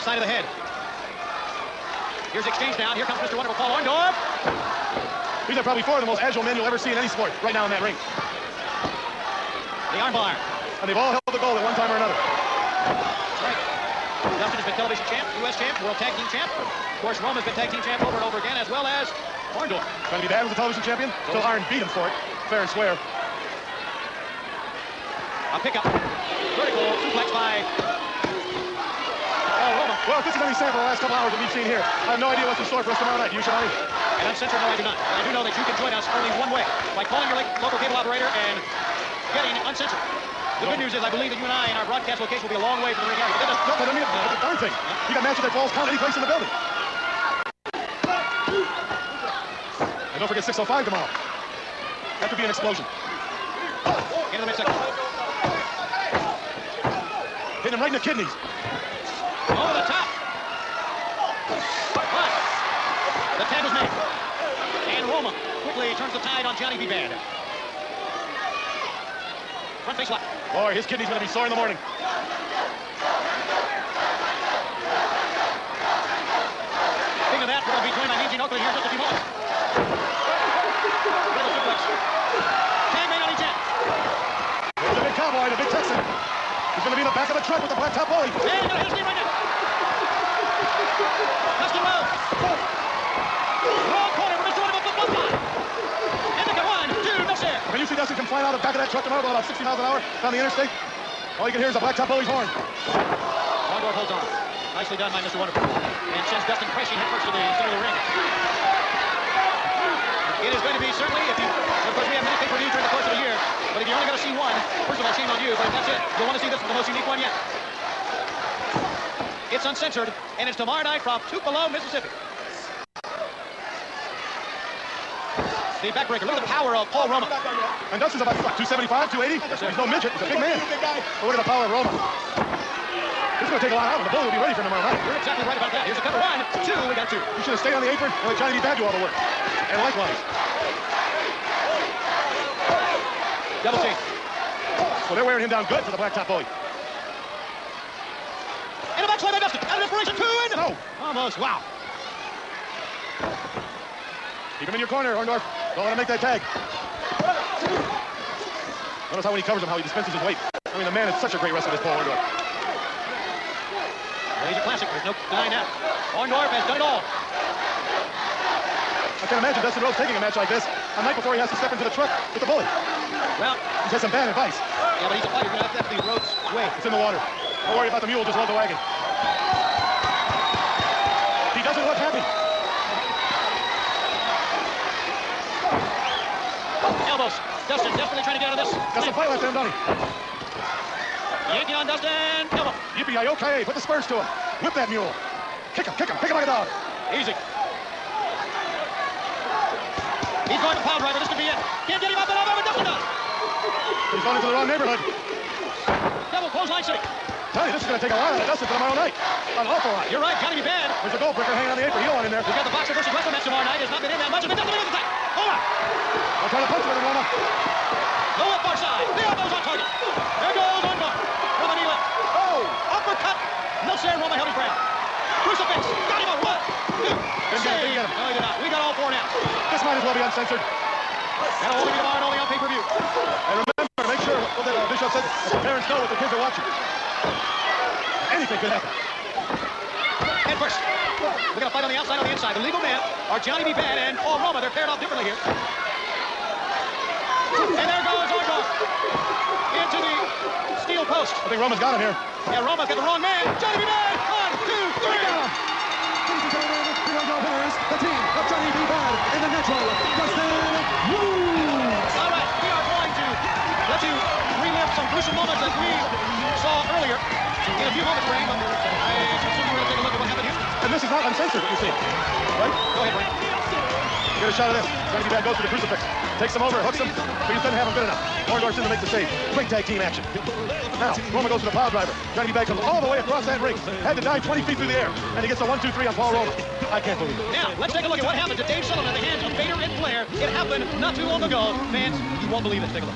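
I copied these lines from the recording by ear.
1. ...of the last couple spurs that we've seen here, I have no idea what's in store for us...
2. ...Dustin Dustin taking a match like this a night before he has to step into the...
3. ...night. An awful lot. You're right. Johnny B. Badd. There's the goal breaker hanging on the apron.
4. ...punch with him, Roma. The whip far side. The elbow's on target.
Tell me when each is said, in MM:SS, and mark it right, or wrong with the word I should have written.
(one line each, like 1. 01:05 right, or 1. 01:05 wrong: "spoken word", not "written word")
1. 00:30 wrong: "hours", not "spurs"
2. 02:49 wrong: "Rhodes", not "Dustin"
3. 03:28 right
4. 03:36 right.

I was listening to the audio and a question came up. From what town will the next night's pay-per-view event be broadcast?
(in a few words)
Tupelo, Mississippi.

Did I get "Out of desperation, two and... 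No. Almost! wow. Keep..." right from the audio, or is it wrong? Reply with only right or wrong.
right.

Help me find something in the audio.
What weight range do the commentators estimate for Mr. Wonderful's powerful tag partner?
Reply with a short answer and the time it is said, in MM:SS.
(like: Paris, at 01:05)
275, 280, at 02:08.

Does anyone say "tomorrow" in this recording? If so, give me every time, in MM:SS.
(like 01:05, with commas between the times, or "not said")
00:33, 00:50, 01:39, 02:00, 02:14, 03:28, 03:33, 03:51.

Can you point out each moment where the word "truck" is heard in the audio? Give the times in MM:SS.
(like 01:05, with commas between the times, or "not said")
01:38, 02:51.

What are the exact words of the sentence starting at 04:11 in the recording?
I think Roma's got him here.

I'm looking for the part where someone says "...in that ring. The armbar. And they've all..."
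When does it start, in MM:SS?
00:07.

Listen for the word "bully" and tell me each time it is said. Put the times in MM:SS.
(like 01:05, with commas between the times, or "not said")
01:42, 02:14, 02:26, 02:52.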